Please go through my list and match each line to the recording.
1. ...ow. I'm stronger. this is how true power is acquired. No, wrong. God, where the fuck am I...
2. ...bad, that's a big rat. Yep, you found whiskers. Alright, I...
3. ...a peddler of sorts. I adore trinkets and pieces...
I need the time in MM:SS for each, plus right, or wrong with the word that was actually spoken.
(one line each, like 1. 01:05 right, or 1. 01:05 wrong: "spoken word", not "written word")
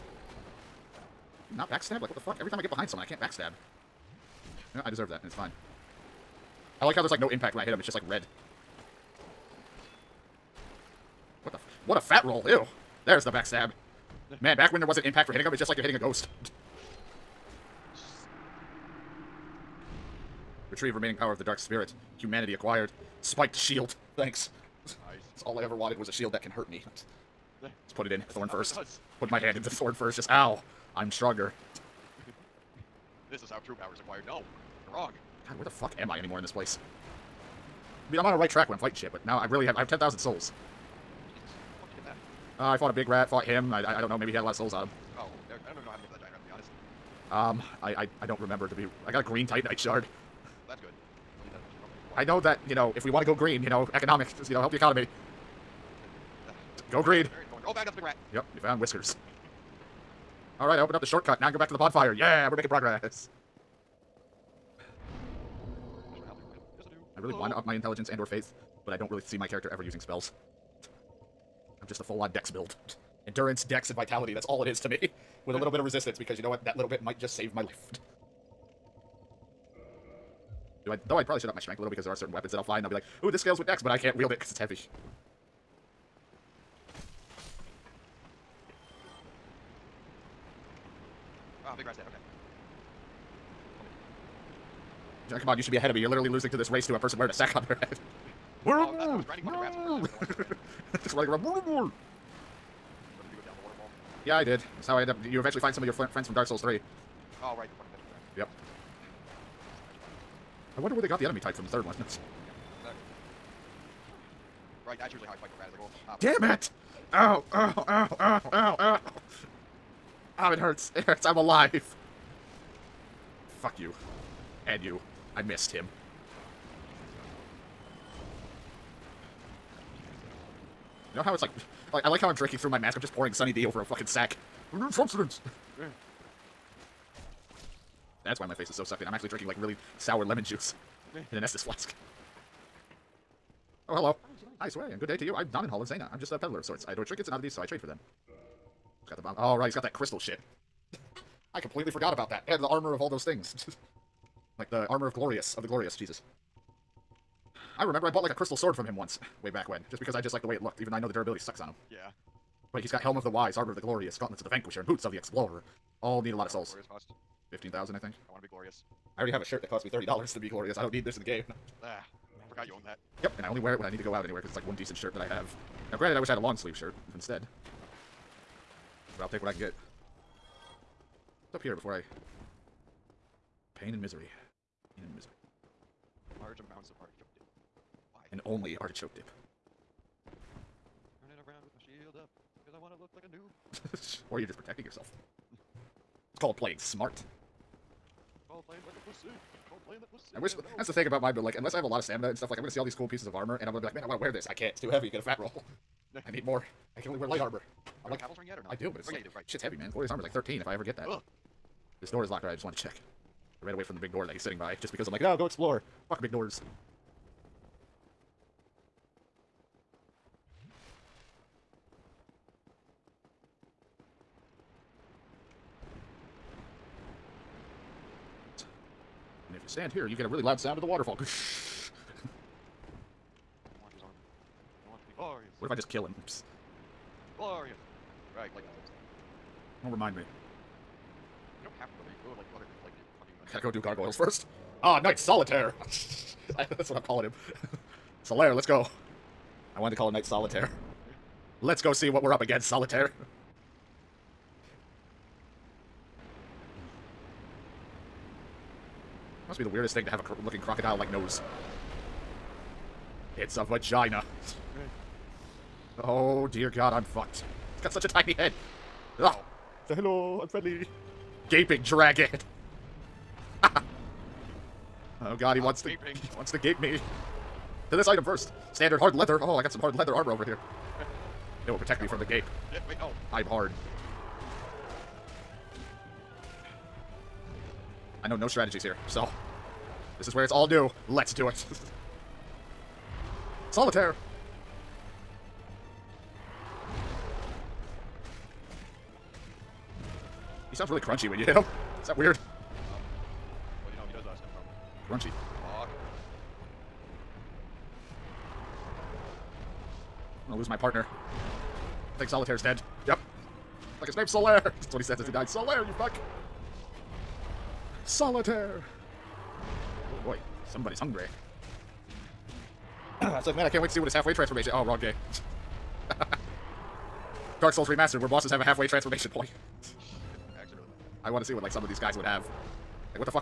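1. 00:30 right
2. 00:57 right
3. 02:26 wrong: "oddities", not "pieces".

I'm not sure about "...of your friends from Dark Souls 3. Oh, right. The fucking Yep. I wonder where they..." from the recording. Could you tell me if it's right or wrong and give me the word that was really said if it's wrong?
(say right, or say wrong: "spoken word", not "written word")
right.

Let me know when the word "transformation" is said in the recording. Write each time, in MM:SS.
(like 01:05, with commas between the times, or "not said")
05:24, 05:28.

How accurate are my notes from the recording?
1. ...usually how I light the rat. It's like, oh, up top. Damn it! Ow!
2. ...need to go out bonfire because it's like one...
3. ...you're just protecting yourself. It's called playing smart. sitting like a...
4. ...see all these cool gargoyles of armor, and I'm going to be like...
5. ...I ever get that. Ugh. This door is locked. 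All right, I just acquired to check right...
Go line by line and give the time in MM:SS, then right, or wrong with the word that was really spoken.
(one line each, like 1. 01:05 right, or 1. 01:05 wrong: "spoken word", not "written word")
1. 01:55 wrong: "fight", not "light"
2. 02:53 wrong: "anywhere", not "bonfire"
3. 03:14 wrong: "playing", not "sitting"
4. 03:22 wrong: "pieces", not "gargoyles"
5. 03:30 wrong: "wanted", not "acquired".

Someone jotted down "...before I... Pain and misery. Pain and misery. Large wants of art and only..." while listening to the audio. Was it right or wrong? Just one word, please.
wrong.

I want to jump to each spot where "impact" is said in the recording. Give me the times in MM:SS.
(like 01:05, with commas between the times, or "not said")
00:07, 00:15.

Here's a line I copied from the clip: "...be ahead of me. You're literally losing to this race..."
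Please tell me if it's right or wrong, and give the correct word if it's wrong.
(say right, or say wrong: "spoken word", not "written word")
right.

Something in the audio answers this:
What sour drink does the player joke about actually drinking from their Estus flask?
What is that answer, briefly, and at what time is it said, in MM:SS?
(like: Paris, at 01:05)
lemon juice, at 02:19.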